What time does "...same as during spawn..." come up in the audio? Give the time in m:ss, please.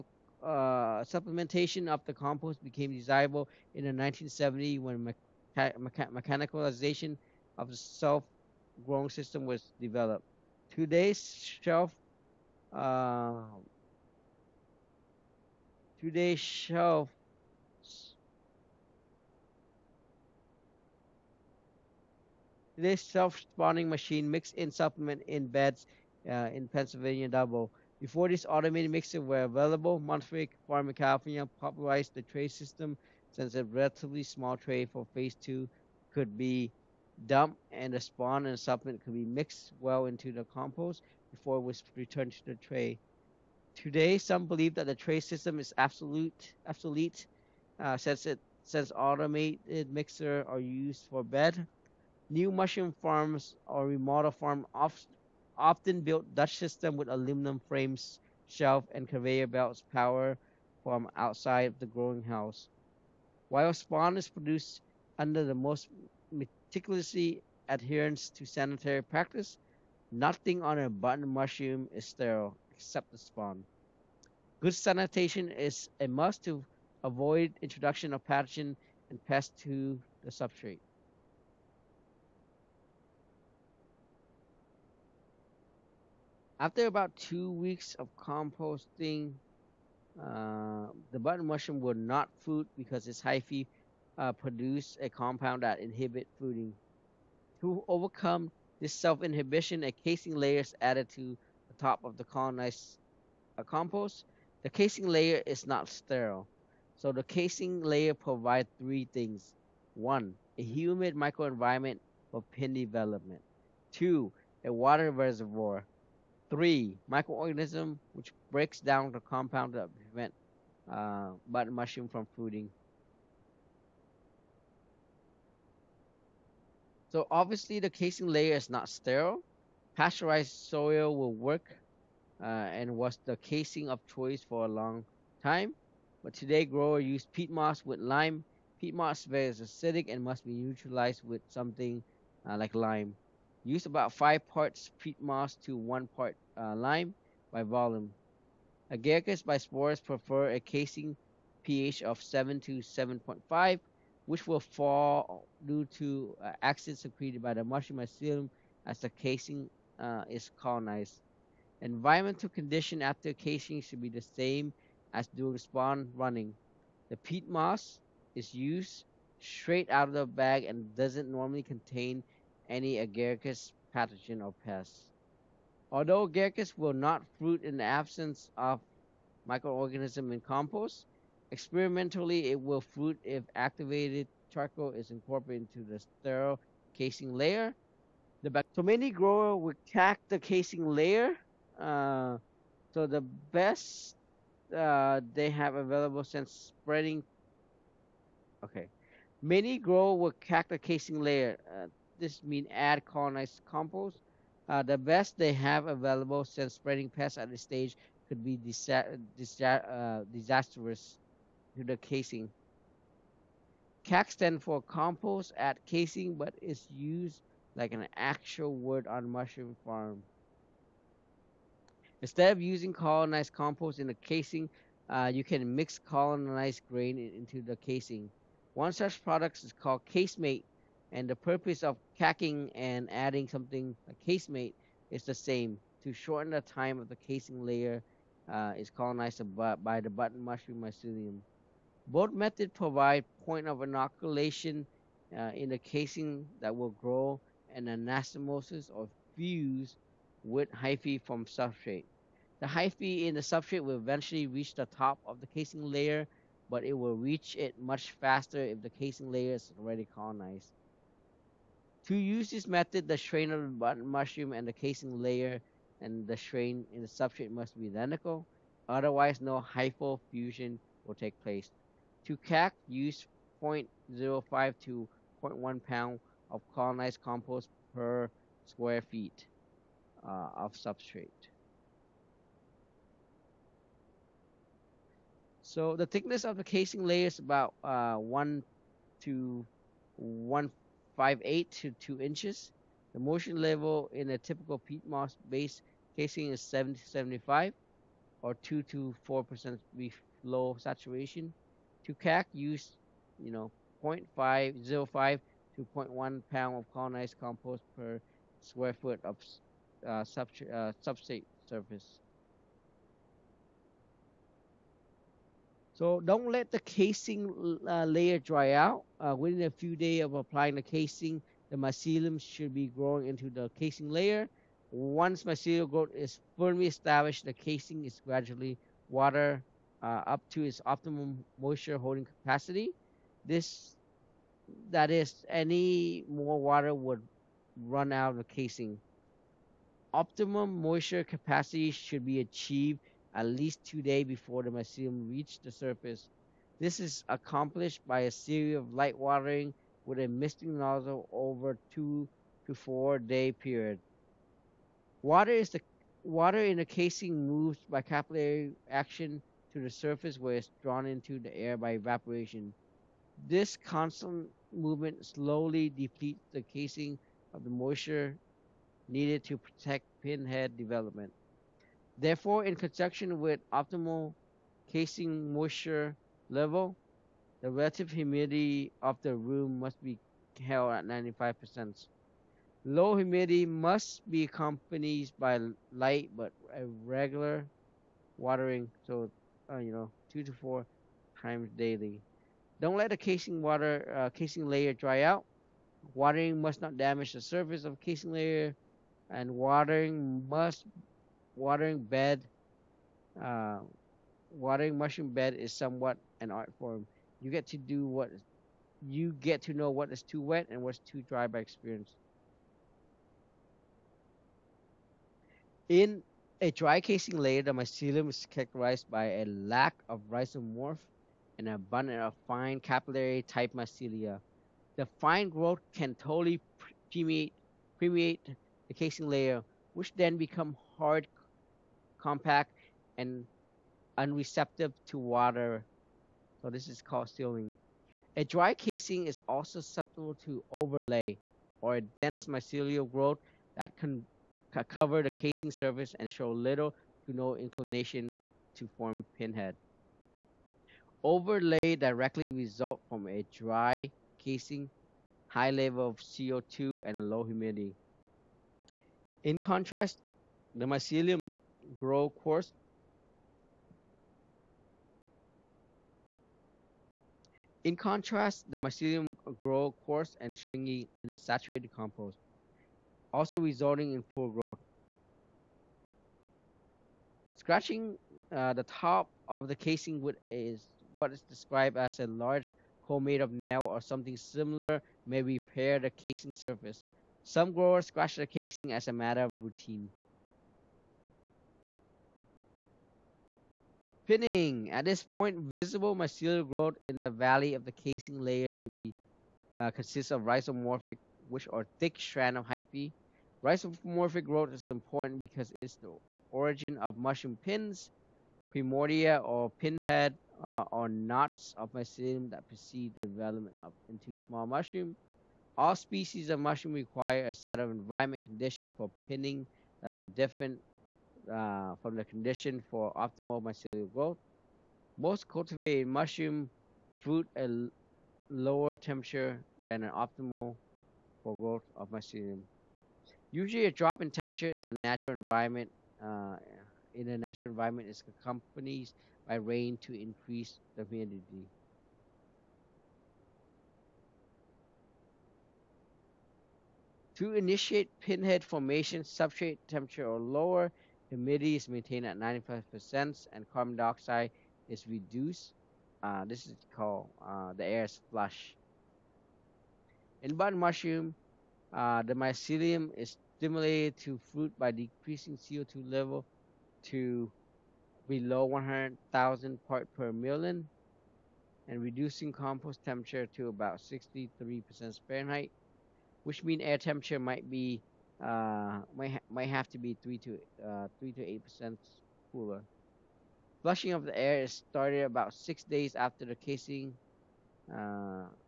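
2:44.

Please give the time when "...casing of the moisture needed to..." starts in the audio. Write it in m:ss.
6:06.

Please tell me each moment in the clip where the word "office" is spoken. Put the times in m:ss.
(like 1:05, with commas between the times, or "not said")
not said.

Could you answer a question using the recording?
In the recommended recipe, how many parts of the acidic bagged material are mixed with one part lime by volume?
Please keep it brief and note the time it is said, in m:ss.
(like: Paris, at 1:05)
5, at 2:24.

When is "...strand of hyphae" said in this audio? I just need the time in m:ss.
8:22.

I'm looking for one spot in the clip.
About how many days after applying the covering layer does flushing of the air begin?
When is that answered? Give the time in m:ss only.
9:45.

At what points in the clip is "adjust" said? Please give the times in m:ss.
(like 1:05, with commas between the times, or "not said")
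not said.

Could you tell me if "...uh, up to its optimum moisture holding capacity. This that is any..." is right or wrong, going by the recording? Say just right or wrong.
right.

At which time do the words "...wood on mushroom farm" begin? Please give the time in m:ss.
3:38.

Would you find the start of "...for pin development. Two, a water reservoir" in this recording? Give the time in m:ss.
1:52.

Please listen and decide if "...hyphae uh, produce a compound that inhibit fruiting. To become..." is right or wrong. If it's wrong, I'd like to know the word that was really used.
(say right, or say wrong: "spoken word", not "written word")
wrong: "overcome", not "become".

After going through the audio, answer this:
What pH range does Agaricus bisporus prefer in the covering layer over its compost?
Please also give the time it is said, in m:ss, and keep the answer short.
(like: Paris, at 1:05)
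7 to 7.5, at 2:32.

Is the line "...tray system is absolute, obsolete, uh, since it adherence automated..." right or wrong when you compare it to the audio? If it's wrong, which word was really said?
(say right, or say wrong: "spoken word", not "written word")
wrong: "since", not "adherence".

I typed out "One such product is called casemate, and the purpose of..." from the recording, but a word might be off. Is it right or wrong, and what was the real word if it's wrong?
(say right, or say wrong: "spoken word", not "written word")
right.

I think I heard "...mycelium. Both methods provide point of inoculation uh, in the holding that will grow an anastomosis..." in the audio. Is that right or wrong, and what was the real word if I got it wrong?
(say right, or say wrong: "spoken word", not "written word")
wrong: "casing", not "holding".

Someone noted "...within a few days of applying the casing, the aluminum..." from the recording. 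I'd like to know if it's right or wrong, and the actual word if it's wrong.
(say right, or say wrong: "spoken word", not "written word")
wrong: "mycelium", not "aluminum".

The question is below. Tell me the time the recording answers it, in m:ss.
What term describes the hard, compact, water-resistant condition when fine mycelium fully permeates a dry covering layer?
7:17.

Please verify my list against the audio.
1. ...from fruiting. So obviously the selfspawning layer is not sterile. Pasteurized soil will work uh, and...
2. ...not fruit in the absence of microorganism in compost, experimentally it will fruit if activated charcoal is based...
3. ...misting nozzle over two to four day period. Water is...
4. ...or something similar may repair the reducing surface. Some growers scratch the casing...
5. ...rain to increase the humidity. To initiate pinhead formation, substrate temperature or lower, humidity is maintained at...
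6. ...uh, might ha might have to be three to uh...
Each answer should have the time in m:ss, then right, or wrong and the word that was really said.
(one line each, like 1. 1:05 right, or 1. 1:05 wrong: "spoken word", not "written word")
1. 2:02 wrong: "casing", not "selfspawning"
2. 2:56 wrong: "incorporated", not "based"
3. 5:50 right
4. 8:03 wrong: "casing", not "reducing"
5. 8:59 right
6. 9:38 right.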